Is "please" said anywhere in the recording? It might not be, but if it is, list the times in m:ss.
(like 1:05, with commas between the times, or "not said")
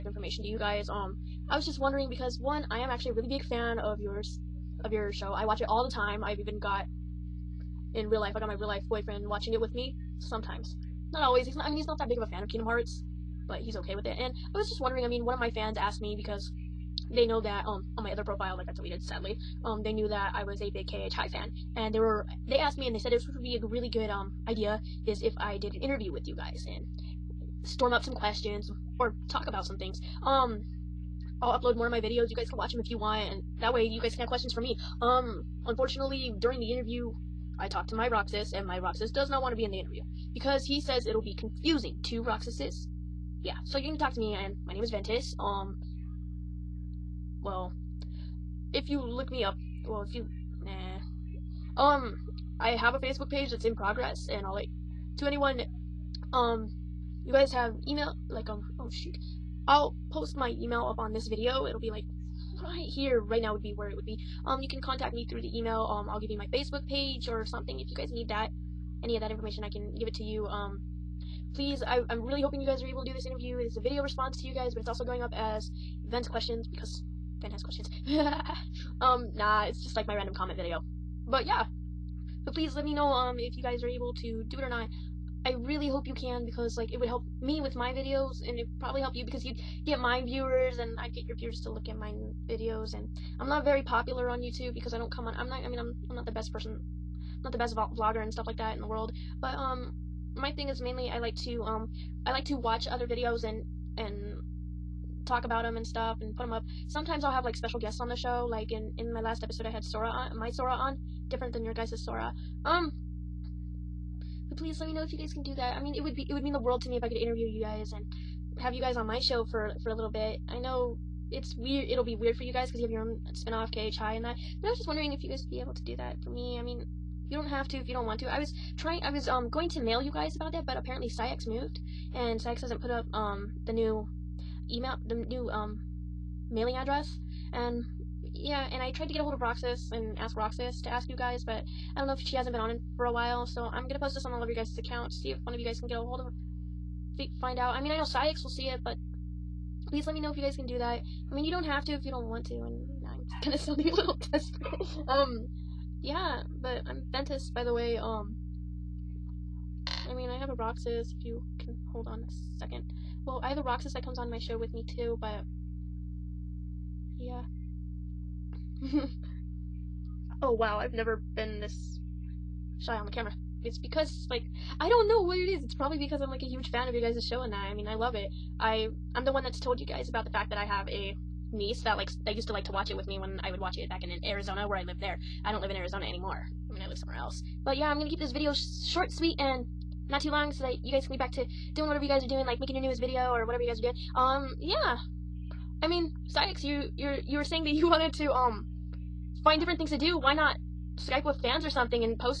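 1:11, 1:22, 1:54, 2:29.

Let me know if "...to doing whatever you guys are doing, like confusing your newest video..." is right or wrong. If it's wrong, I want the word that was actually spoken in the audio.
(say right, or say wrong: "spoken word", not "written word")
wrong: "making", not "confusing".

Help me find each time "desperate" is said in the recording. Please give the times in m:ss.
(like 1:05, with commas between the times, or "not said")
2:34.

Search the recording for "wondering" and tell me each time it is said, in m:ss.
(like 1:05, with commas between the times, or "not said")
0:01, 0:14, 2:04.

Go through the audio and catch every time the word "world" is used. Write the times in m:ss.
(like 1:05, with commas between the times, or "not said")
1:38, 1:56.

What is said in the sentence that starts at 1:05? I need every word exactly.
Um, I'll give you my Facebook page or something if you guys need that.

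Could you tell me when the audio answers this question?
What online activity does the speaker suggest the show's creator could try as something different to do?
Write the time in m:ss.
3:20.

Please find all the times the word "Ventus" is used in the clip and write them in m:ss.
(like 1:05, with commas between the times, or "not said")
0:44, 2:37.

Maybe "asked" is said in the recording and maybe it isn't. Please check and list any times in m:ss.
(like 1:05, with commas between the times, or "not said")
0:15, 0:22.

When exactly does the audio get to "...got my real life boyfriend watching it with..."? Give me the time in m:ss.
0:08.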